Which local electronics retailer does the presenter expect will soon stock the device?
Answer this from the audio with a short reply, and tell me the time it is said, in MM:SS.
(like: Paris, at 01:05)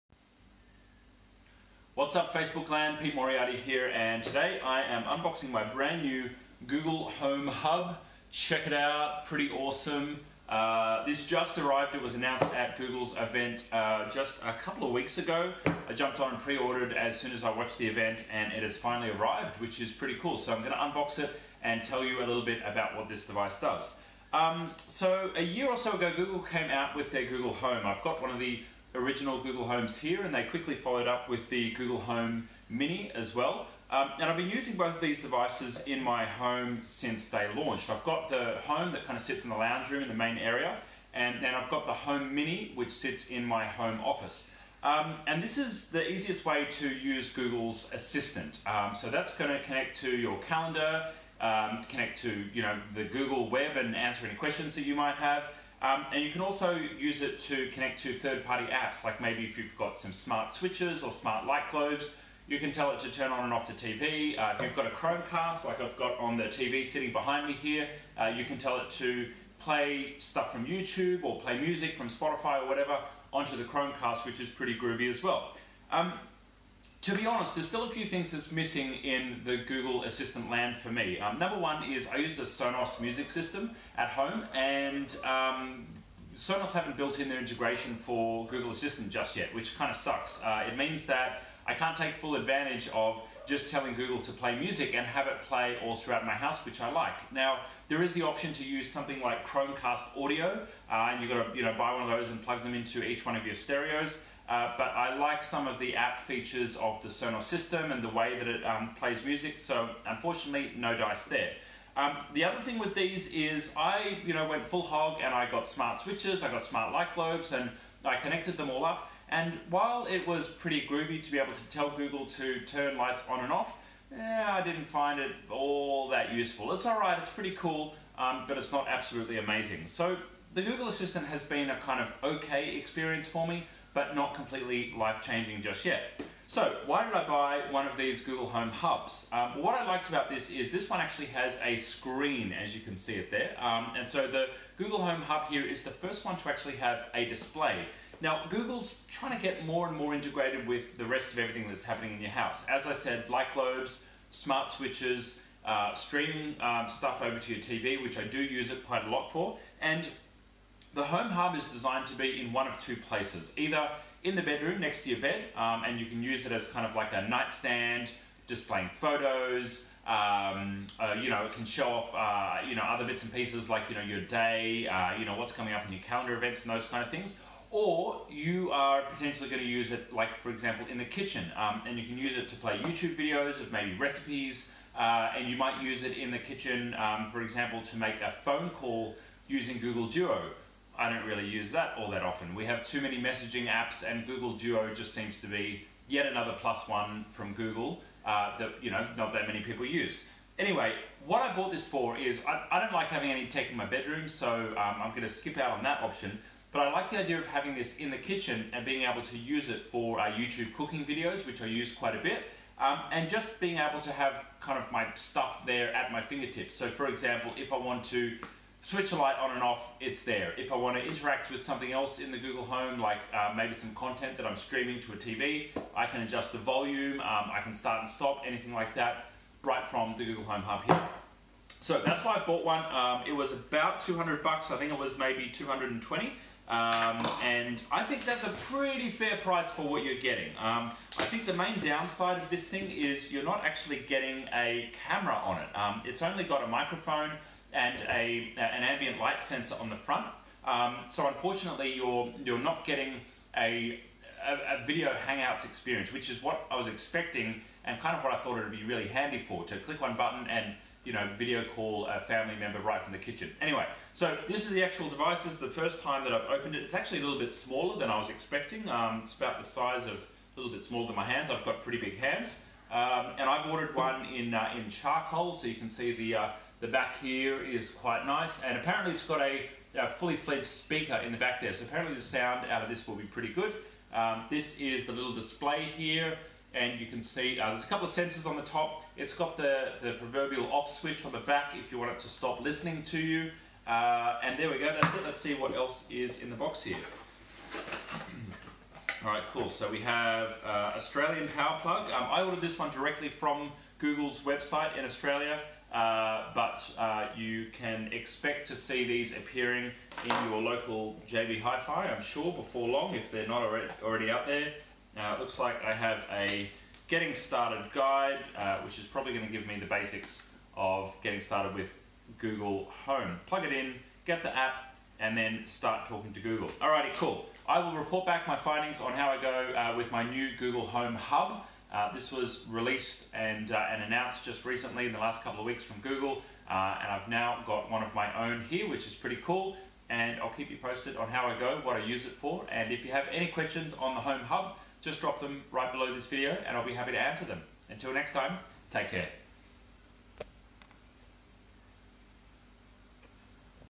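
JB Hi-Fi, at 05:11.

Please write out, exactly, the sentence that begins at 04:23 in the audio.
Anyway, so this is the actual device.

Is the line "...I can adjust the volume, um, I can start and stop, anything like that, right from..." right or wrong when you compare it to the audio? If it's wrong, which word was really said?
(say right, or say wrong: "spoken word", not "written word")
right.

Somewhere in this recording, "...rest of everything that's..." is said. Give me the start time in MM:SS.
02:31.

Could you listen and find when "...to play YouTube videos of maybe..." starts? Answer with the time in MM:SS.
03:02.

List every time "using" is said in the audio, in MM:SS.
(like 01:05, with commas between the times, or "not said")
00:34, 03:09.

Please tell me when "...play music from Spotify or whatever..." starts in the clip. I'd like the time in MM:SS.
01:11.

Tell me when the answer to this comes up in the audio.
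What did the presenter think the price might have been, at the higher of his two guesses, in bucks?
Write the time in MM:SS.
03:55.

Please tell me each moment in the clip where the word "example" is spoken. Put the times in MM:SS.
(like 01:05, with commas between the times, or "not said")
03:00, 03:07, 03:37.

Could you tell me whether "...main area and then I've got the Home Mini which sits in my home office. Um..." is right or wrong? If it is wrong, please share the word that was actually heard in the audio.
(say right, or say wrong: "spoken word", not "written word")
right.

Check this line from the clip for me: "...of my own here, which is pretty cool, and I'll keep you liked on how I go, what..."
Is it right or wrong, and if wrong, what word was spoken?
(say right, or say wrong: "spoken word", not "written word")
wrong: "posted", not "liked".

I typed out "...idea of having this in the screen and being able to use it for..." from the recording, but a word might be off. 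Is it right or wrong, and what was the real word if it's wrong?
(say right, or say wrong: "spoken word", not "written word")
wrong: "kitchen", not "screen".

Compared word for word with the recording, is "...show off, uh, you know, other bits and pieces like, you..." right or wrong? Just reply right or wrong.
right.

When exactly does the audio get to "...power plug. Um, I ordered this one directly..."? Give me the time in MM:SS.
05:01.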